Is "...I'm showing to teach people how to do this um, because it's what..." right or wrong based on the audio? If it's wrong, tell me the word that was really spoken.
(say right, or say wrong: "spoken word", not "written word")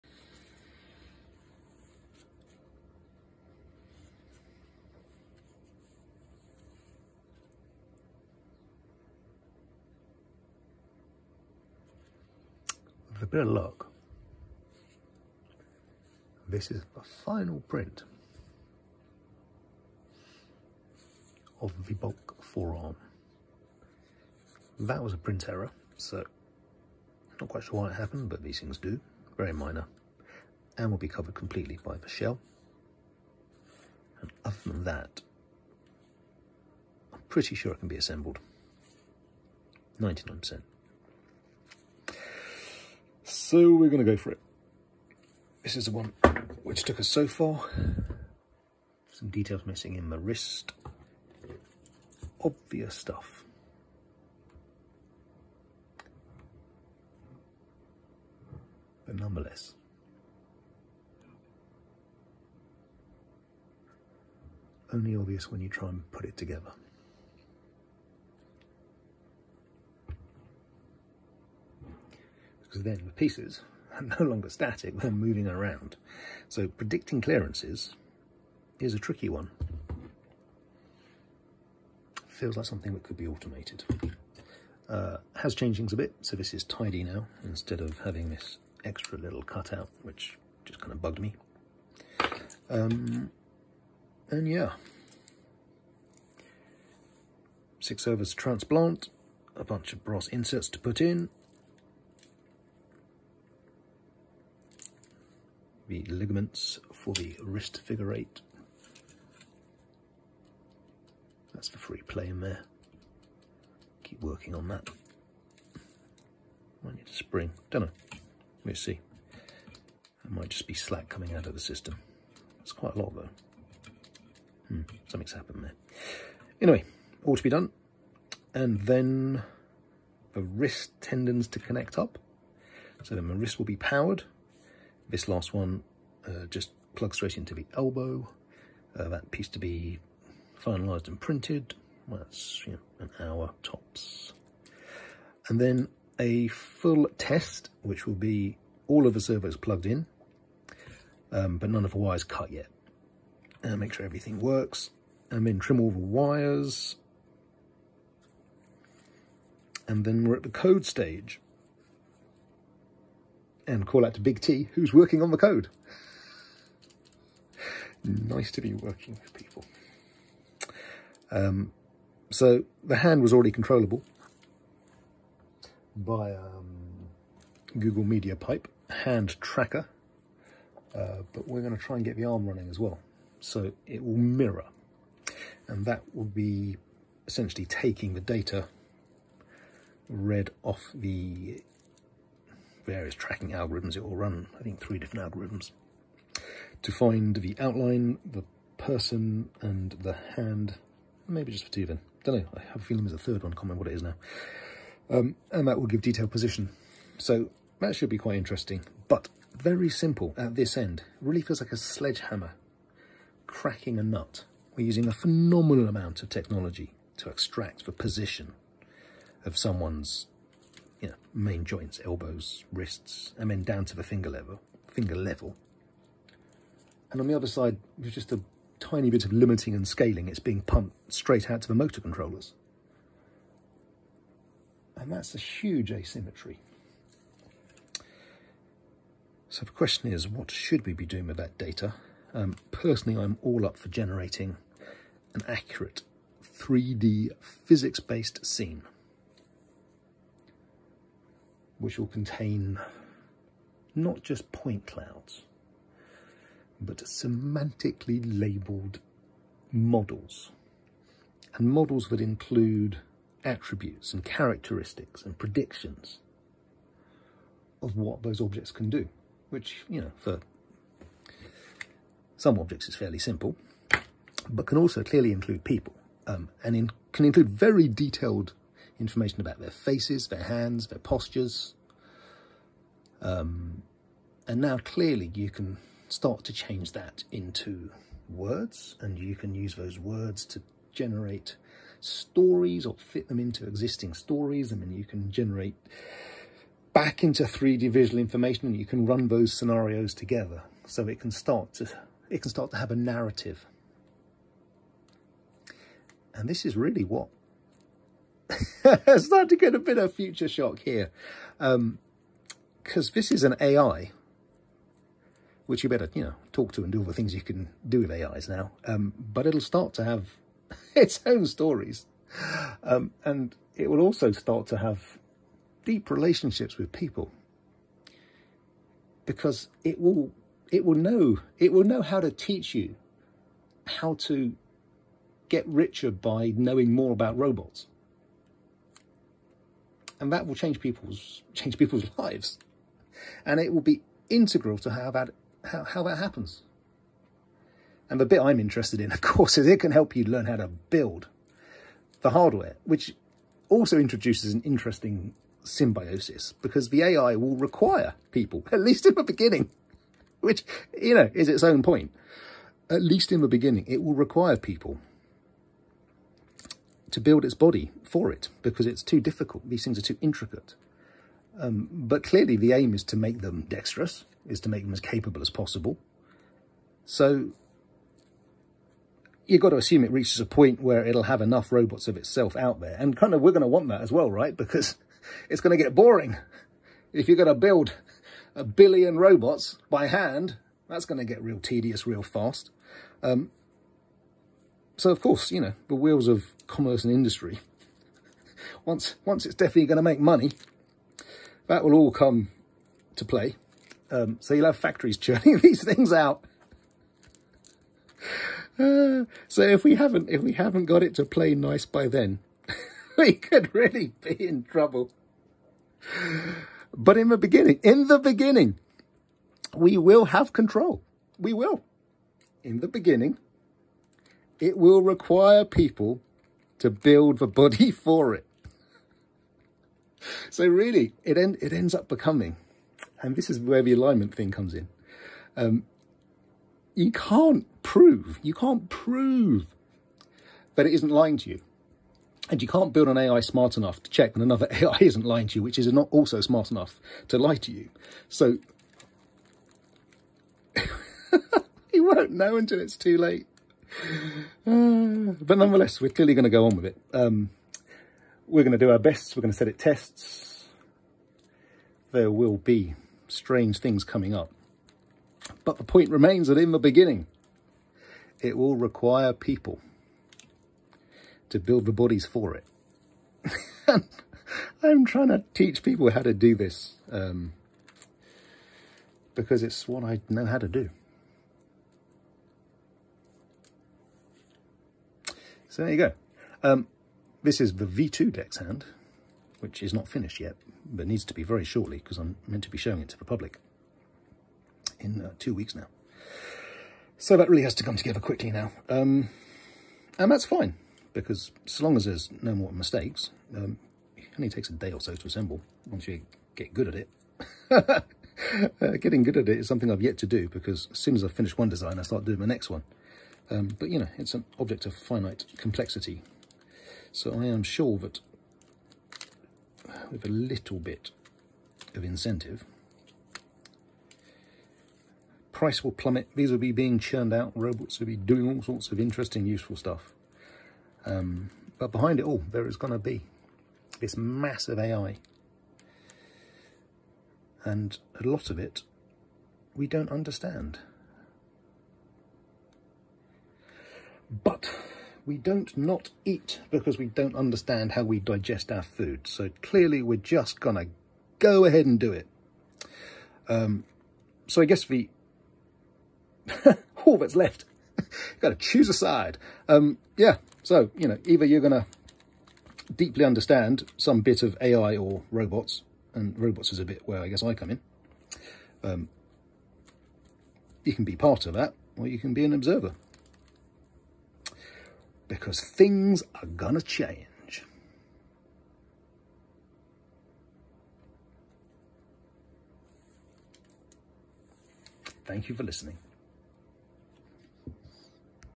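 wrong: "trying", not "showing".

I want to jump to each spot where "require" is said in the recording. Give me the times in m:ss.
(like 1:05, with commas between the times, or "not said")
5:57, 6:04, 7:05, 7:48.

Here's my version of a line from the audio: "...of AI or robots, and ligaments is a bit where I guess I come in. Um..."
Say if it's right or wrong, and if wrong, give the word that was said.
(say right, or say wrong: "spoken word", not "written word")
wrong: "robots", not "ligaments".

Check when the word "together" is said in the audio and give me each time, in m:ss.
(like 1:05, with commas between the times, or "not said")
1:06, 5:00, 8:17.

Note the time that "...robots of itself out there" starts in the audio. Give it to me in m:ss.
6:21.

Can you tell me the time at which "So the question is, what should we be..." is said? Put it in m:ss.
3:59.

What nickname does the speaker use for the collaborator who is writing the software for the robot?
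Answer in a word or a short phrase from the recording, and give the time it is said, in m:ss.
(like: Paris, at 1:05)
Big T, at 2:44.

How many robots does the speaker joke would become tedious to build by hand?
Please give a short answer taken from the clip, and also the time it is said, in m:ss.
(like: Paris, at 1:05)
a billion, at 6:28.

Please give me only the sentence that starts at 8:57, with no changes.
And a lot of it we don't understand.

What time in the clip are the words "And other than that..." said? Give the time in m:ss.
0:34.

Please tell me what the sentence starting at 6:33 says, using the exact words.
Um, so, of course, you know, the wheels of commerce and industry.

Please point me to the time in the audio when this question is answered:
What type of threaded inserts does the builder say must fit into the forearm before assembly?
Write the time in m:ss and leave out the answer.
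1:40.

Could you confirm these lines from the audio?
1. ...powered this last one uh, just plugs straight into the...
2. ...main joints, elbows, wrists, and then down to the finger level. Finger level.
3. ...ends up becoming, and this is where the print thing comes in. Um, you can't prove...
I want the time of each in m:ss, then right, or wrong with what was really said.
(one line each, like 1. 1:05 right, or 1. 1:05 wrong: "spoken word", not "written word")
1. 2:13 right
2. 3:41 right
3. 7:11 wrong: "alignment", not "print".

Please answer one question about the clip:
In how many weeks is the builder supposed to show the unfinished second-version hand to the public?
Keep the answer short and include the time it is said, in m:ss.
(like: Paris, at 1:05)
2 weeks, at 8:15.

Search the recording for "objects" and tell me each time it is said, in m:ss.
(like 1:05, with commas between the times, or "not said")
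4:28, 4:32, 8:34.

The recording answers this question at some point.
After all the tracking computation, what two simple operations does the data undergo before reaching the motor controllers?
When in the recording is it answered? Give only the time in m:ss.
3:49.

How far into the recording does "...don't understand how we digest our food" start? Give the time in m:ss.
9:07.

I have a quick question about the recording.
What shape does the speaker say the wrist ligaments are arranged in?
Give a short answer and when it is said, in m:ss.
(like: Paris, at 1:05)
figure eight, at 1:47.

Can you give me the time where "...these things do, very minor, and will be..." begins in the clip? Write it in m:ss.
0:28.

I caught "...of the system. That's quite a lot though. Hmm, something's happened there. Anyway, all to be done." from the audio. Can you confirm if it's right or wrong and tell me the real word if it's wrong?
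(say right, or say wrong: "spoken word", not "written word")
right.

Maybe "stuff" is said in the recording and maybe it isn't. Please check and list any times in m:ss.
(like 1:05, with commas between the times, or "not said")
0:52, 8:49.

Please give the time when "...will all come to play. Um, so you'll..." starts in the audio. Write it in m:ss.
6:41.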